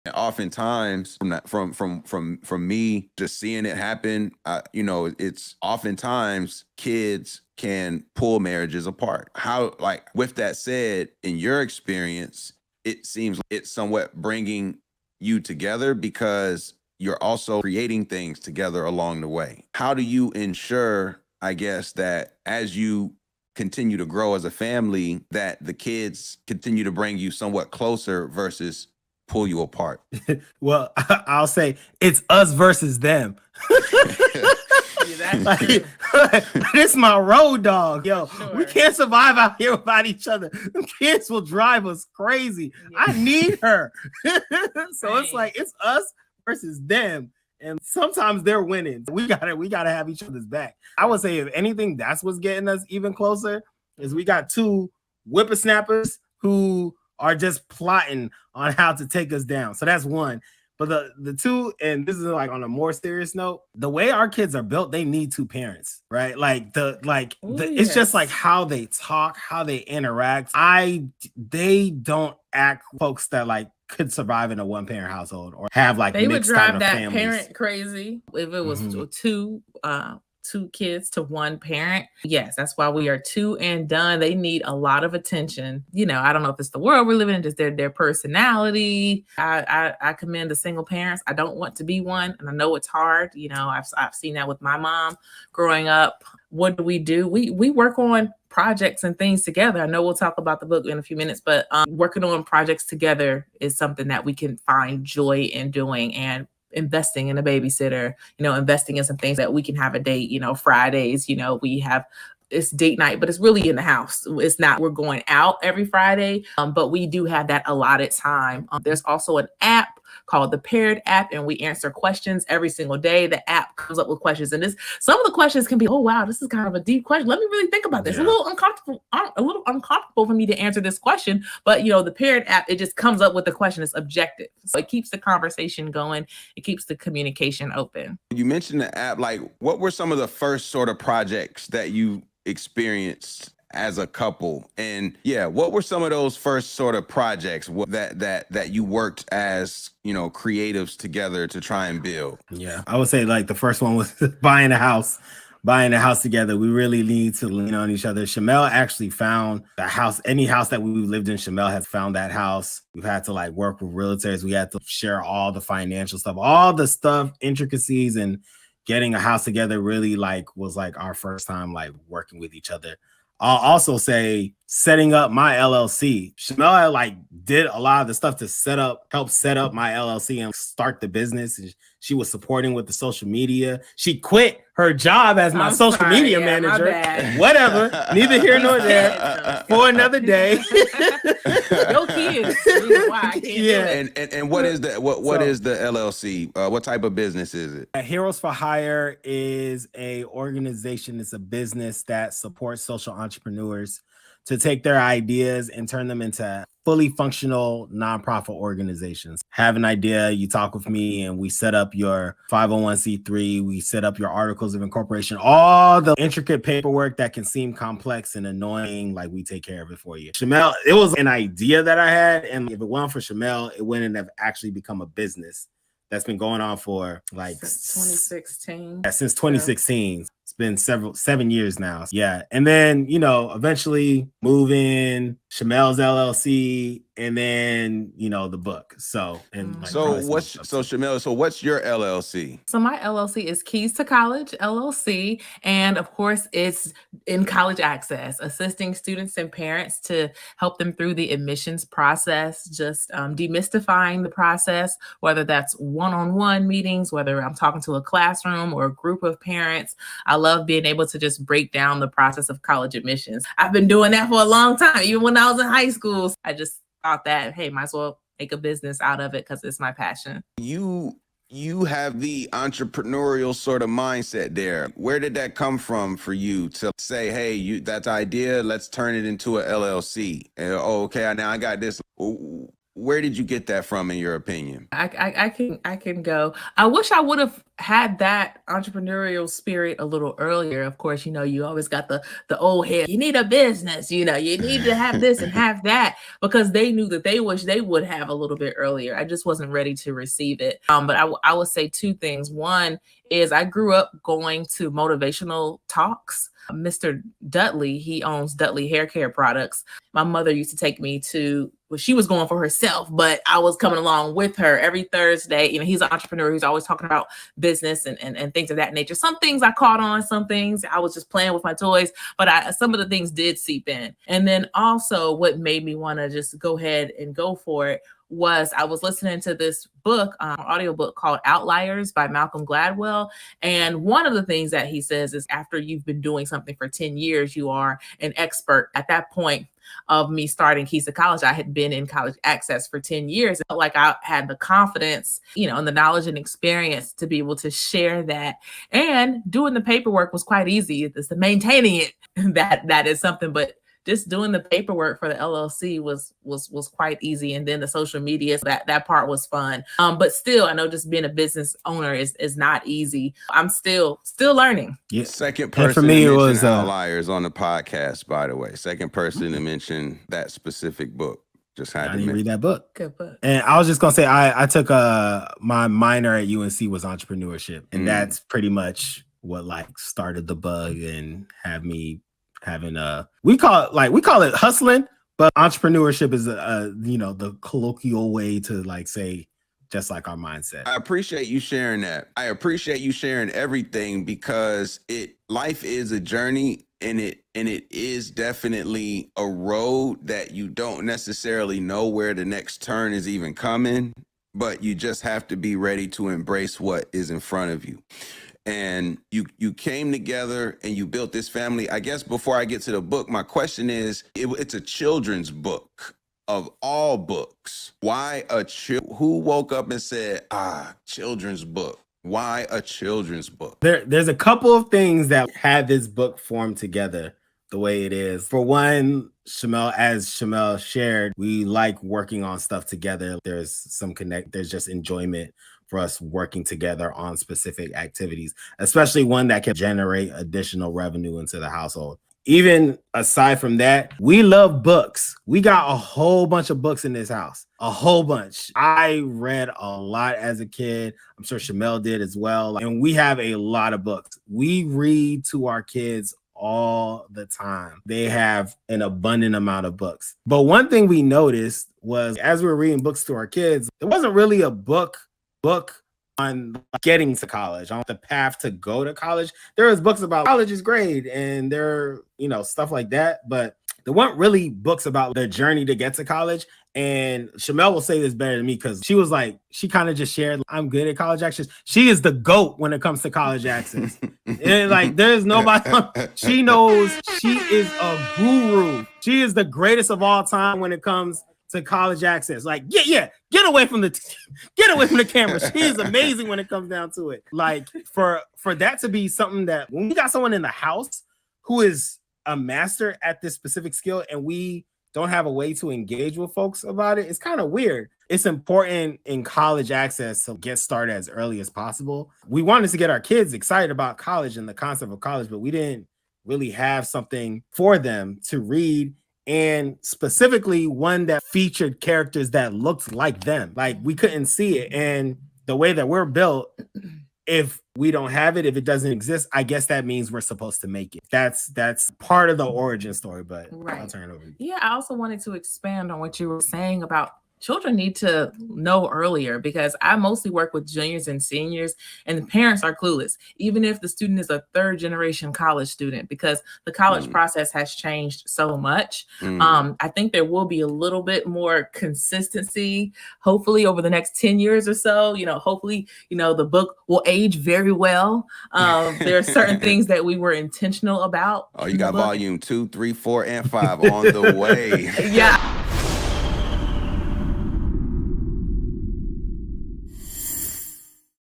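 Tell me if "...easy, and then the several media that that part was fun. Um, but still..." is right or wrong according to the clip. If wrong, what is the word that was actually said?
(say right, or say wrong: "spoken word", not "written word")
wrong: "social", not "several".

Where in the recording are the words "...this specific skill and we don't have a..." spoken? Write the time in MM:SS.
08:23.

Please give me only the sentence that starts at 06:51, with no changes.
I guess before I get to the book, my question is: it, it's a children's book of all books.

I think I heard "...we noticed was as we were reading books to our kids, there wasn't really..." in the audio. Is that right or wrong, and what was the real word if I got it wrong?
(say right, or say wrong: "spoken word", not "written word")
right.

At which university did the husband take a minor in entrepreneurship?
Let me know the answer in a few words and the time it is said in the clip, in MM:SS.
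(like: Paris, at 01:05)
UNC, at 06:16.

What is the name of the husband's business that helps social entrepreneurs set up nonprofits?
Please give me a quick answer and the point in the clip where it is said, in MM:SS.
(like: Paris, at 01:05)
Heroes for Hire, at 03:18.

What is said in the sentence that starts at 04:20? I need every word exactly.
I love being able to just break down the process of college admissions.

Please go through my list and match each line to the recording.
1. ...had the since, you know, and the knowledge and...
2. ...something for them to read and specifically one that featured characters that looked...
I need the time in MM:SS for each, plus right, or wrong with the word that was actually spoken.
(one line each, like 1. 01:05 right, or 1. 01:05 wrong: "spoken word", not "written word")
1. 05:44 wrong: "confidence", not "since"
2. 08:37 right.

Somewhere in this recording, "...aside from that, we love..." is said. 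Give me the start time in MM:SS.
07:23.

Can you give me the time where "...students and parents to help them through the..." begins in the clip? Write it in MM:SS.
04:08.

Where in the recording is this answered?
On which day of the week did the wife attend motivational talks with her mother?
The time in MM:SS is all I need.
05:15.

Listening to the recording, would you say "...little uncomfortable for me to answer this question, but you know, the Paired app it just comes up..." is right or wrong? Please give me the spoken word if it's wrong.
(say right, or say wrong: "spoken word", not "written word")
right.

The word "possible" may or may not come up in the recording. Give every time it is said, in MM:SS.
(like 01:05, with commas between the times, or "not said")
08:31.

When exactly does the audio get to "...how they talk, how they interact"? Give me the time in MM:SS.
01:08.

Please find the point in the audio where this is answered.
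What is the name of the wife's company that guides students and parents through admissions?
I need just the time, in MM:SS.
04:03.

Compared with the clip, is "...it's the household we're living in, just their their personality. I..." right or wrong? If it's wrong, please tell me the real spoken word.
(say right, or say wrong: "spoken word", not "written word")
wrong: "world", not "household".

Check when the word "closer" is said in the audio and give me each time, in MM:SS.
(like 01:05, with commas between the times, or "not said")
00:27, 00:53.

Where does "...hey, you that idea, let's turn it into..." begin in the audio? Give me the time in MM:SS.
04:37.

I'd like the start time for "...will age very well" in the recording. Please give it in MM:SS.
09:17.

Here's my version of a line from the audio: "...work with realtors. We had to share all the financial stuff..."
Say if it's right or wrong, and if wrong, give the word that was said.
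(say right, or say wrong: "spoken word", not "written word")
right.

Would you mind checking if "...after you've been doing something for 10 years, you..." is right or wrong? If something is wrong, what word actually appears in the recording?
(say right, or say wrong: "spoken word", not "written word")
right.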